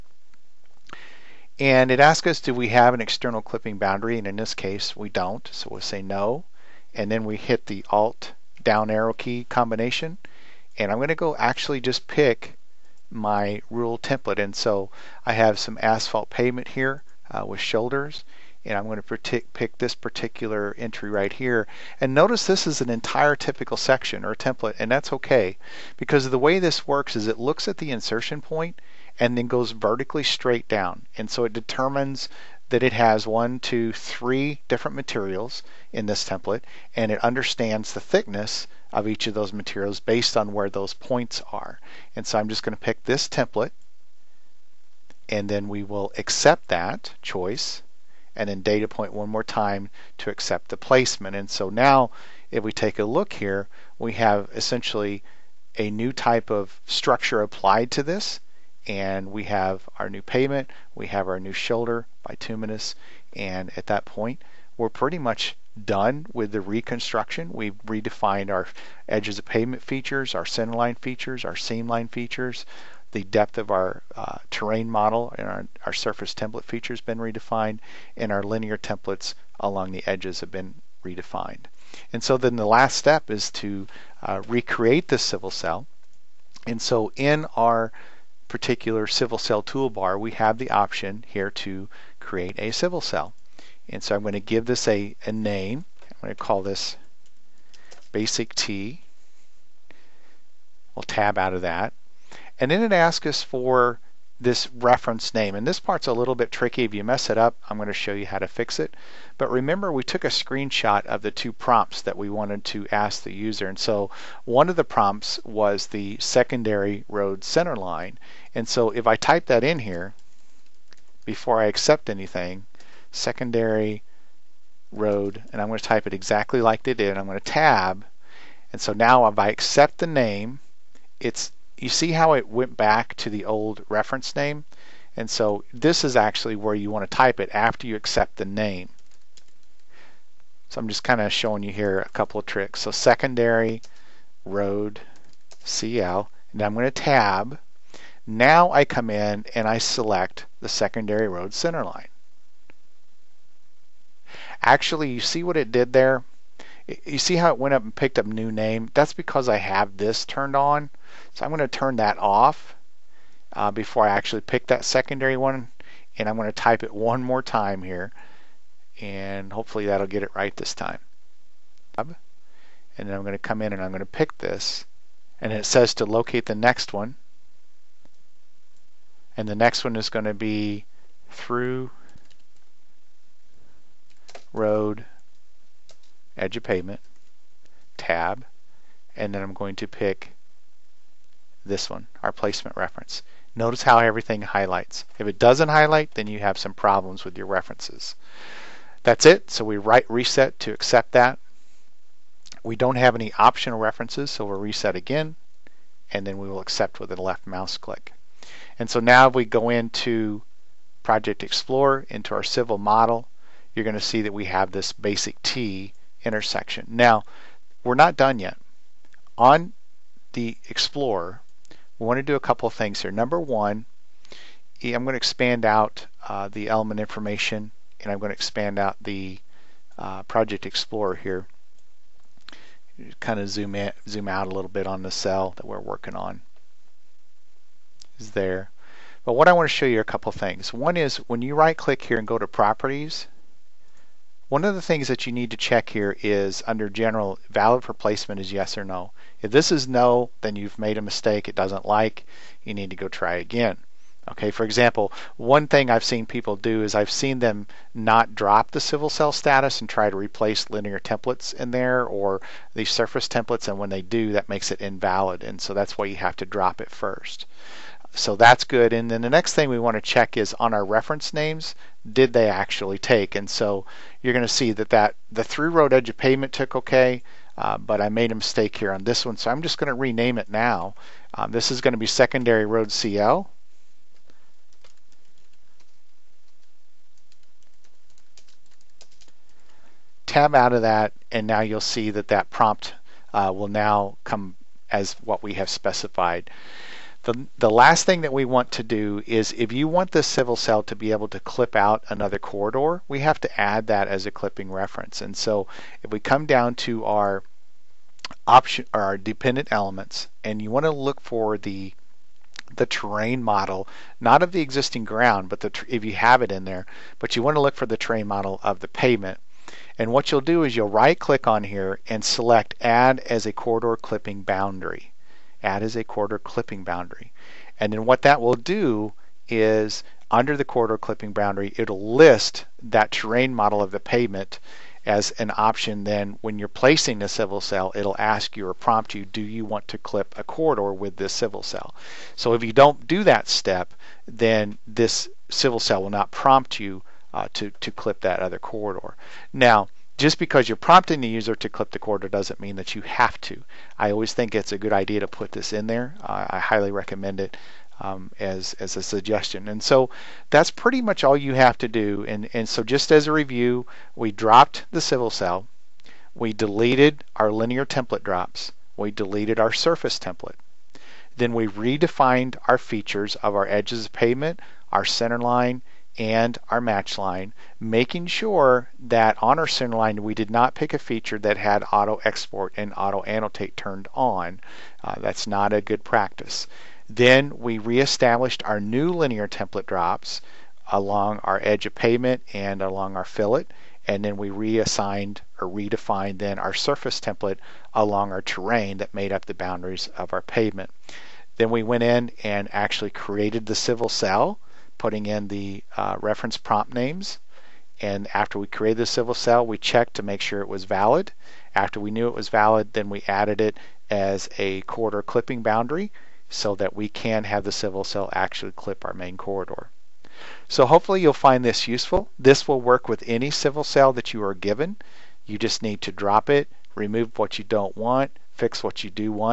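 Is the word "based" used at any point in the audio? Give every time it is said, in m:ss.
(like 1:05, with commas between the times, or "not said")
0:39.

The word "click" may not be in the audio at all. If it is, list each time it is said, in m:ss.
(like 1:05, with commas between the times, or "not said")
3:27, 4:01, 5:21.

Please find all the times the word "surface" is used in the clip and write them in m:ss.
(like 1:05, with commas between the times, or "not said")
1:15, 4:22, 6:09, 6:36.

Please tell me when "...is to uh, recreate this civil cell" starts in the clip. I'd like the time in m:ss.
1:23.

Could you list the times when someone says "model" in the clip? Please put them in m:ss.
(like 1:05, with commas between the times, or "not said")
1:14, 3:32, 5:13, 5:18, 5:33.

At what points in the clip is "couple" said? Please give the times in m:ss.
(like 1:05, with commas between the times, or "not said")
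2:22, 3:42, 4:00.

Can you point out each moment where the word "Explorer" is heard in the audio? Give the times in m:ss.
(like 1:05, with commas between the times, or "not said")
3:31, 3:40, 3:50.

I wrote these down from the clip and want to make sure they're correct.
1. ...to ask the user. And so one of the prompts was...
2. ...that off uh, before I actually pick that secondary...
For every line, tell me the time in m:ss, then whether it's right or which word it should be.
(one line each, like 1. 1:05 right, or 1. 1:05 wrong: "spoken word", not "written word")
1. 1:52 right
2. 2:41 right.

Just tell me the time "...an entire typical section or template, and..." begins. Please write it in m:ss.
0:22.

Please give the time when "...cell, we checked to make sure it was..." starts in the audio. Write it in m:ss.
6:49.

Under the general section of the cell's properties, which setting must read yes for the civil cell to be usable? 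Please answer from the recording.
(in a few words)
valid for placement.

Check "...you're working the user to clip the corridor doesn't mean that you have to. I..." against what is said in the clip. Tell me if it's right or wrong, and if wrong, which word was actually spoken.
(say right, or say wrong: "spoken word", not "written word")
wrong: "prompting", not "working".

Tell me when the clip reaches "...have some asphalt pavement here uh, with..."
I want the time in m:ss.
0:15.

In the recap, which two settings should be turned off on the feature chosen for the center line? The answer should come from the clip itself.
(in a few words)
auto export and auto annotate.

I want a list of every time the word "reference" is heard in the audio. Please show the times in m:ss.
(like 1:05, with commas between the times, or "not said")
1:44, 2:13, 3:12, 3:17, 3:23, 4:30, 5:04, 6:46.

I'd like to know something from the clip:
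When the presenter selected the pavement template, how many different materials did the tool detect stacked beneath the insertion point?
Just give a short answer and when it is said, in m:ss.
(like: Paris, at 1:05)
3, at 0:33.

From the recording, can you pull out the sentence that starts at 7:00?
So hopefully you'll find this useful.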